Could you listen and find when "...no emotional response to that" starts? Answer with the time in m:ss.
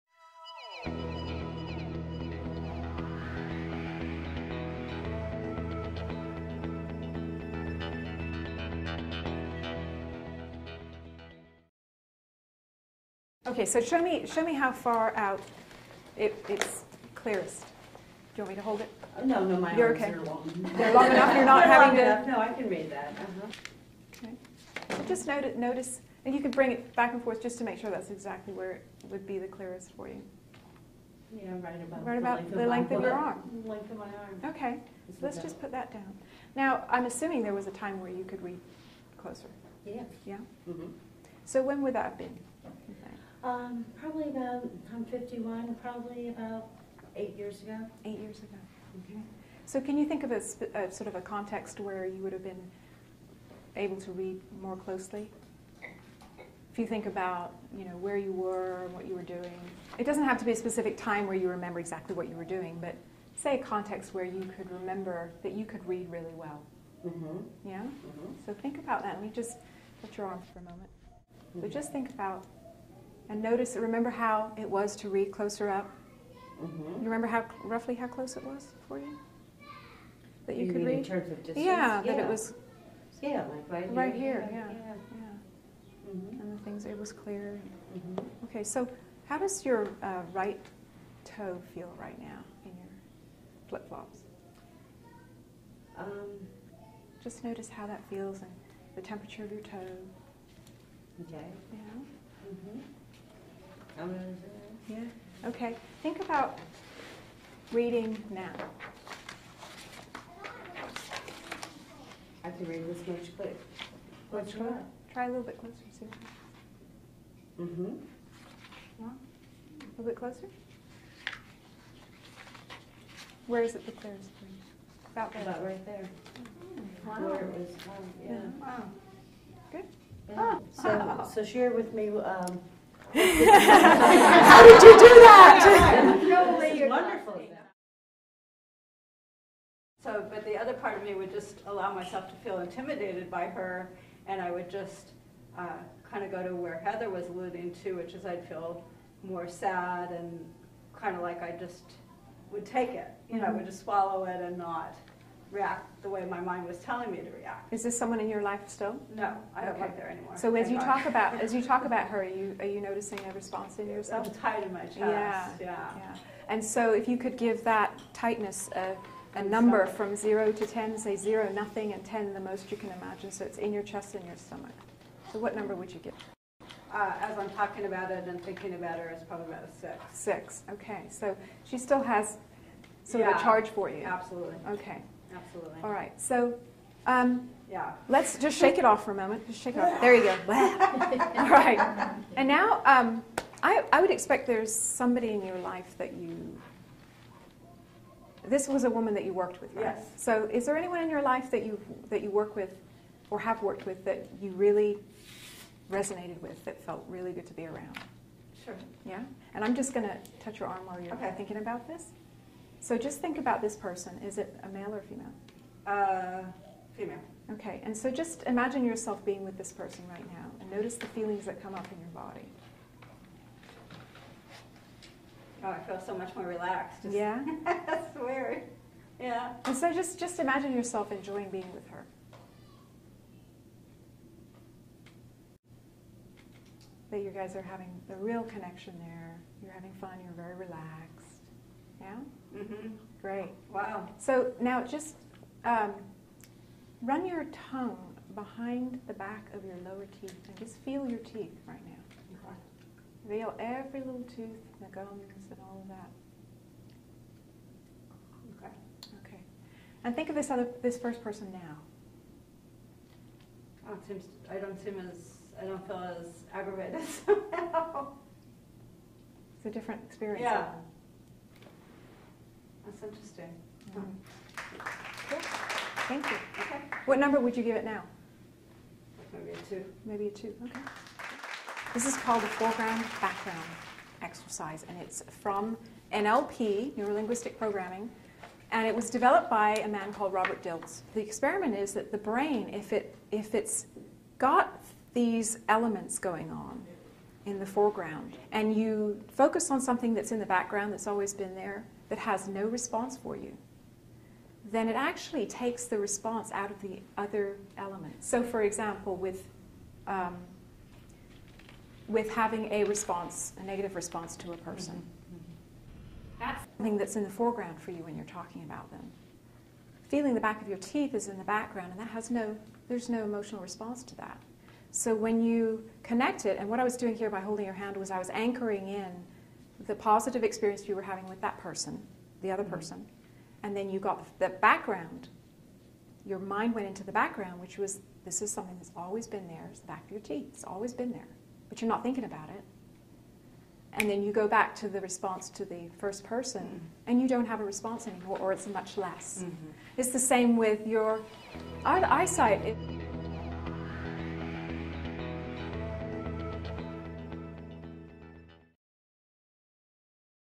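5:23.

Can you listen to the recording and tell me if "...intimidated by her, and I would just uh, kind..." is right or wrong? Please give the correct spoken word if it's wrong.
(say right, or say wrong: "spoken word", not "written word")
right.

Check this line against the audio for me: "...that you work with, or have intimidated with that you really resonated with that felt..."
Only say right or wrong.
wrong.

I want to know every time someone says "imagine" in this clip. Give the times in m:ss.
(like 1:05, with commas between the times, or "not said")
2:53, 3:38, 3:50.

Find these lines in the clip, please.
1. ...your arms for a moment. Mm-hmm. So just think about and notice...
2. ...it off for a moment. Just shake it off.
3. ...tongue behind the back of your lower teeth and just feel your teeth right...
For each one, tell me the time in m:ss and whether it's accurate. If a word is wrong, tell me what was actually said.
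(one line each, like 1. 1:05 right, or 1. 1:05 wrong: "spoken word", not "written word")
1. 1:10 right
2. 3:08 right
3. 4:07 right.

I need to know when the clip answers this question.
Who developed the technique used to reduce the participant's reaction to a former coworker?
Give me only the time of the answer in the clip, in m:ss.
4:50.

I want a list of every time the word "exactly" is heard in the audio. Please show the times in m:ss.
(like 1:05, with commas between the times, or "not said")
0:28, 1:01.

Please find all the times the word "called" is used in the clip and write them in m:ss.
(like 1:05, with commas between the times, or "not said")
4:42, 4:50.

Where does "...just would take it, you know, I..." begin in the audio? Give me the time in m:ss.
2:31.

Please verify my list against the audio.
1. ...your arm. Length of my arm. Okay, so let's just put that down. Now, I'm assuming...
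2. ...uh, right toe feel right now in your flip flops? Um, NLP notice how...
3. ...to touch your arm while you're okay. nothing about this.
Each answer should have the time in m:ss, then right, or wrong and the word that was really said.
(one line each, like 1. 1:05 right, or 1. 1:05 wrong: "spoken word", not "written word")
1. 0:33 right
2. 1:30 wrong: "Just", not "NLP"
3. 3:30 wrong: "thinking", not "nothing".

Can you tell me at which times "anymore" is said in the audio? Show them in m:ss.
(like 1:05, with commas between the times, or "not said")
2:40, 5:48.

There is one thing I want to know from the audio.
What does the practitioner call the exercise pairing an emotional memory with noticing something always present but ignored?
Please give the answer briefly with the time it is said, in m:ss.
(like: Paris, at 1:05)
foreground background exercise, at 4:42.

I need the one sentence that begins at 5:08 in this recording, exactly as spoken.
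So, for example, with um, with having a response, a negative response to a person, mm-hmm.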